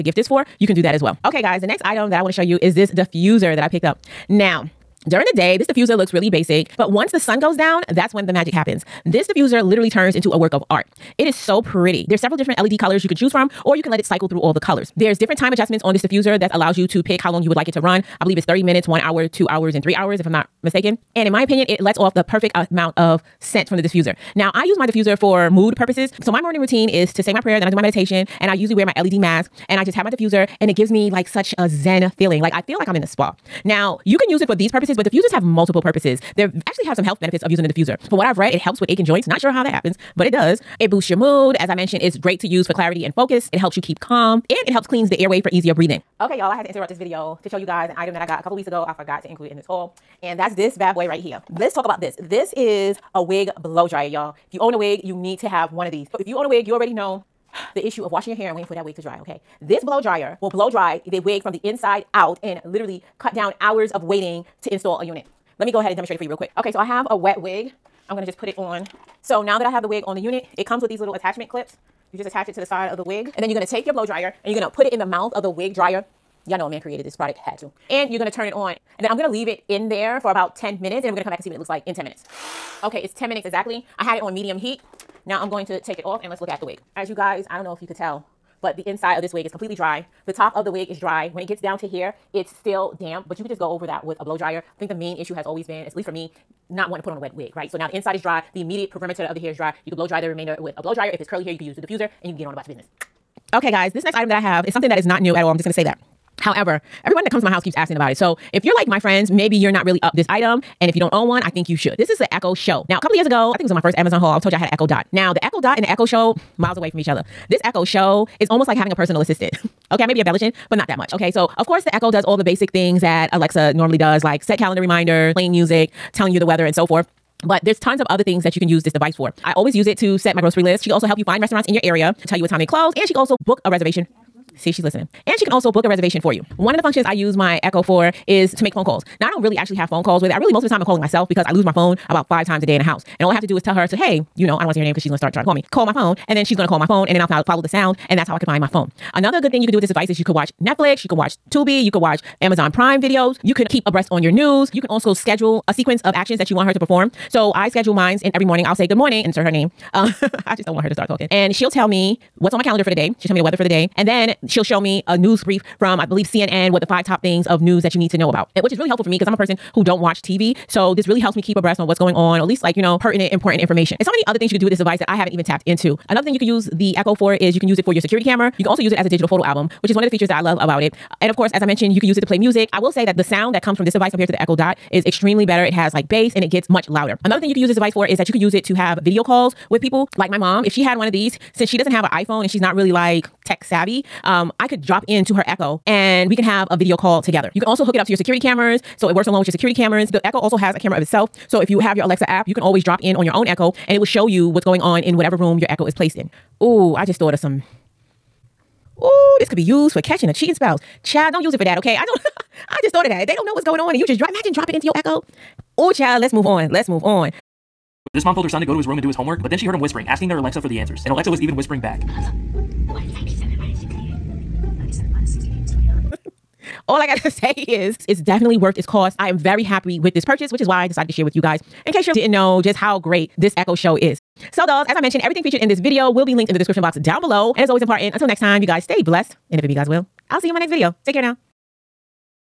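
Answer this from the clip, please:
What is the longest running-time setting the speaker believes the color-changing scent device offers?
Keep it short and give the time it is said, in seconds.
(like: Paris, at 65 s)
3 hours, at 19 s.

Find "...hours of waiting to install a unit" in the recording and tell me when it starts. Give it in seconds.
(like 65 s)
63 s.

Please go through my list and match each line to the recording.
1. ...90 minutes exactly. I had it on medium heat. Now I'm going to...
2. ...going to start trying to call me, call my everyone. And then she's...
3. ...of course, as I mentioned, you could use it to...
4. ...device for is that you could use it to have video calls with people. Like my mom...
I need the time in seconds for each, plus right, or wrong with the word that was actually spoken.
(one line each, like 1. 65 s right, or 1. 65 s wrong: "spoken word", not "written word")
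1. 83 s wrong: "10", not "90"
2. 145 s wrong: "phone", not "everyone"
3. 181 s right
4. 187 s right.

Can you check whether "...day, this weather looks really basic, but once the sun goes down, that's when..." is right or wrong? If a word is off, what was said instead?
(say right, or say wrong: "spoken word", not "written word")
wrong: "diffuser", not "weather".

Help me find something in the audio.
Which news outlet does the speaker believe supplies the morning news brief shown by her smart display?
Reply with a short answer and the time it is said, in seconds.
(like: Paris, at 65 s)
CNN, at 166 s.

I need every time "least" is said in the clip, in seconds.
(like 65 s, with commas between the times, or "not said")
95 s, 172 s.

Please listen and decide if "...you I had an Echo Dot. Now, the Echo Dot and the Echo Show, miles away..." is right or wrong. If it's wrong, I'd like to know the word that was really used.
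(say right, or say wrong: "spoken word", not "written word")
right.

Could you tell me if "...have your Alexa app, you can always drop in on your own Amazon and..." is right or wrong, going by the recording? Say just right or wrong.
wrong.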